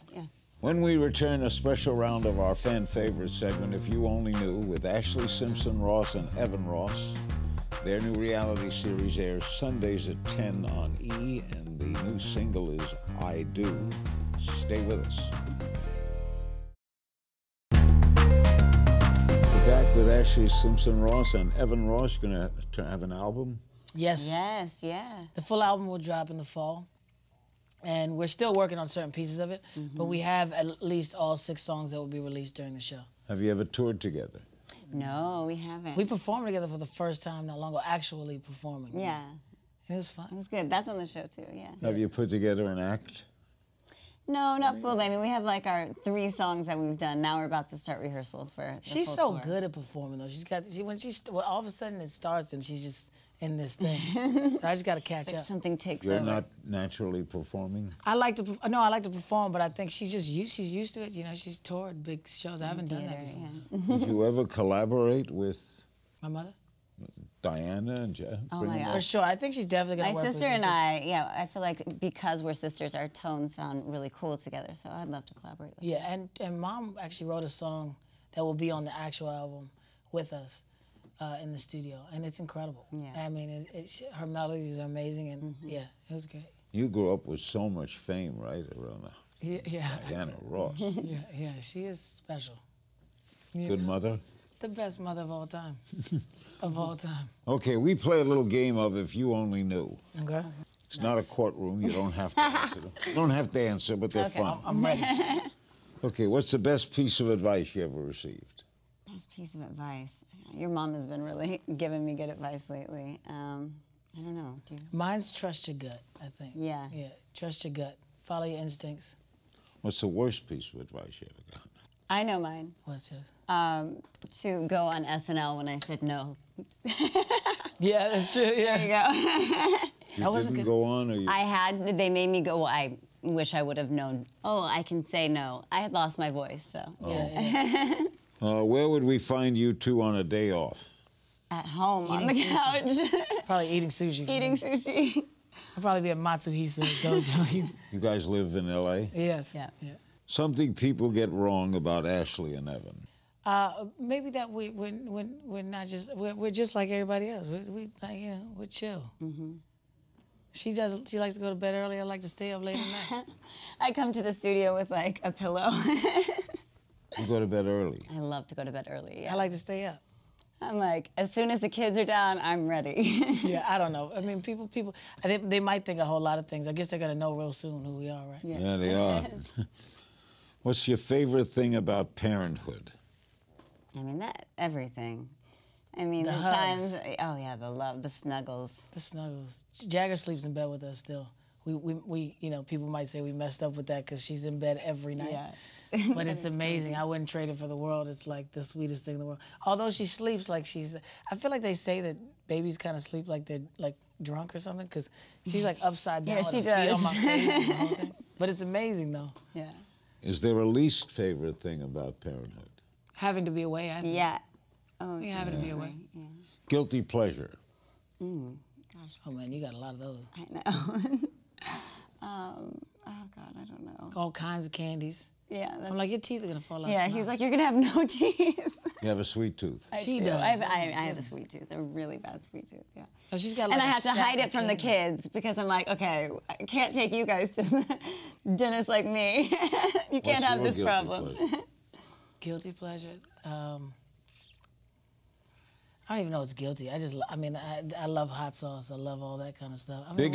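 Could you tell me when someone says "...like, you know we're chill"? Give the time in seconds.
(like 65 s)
157 s.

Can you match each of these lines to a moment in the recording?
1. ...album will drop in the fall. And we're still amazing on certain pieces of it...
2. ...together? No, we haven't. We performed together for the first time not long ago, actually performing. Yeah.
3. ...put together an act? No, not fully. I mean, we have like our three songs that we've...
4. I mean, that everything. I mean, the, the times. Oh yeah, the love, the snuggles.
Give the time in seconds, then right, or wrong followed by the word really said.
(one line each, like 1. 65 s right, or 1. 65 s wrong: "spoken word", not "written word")
1. 25 s wrong: "working", not "amazing"
2. 33 s right
3. 42 s right
4. 183 s right.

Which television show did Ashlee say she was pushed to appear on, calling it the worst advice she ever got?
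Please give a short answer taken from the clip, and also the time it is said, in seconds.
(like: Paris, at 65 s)
SNL, at 125 s.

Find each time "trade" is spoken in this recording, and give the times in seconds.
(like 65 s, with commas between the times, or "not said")
197 s.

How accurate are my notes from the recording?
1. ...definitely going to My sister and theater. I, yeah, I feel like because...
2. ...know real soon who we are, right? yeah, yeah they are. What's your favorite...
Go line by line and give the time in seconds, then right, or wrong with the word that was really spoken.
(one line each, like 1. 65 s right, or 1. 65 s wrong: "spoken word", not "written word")
1. 69 s wrong: "sister", not "theater"
2. 177 s right.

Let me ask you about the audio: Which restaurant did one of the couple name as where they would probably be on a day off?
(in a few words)
Matsuhisa.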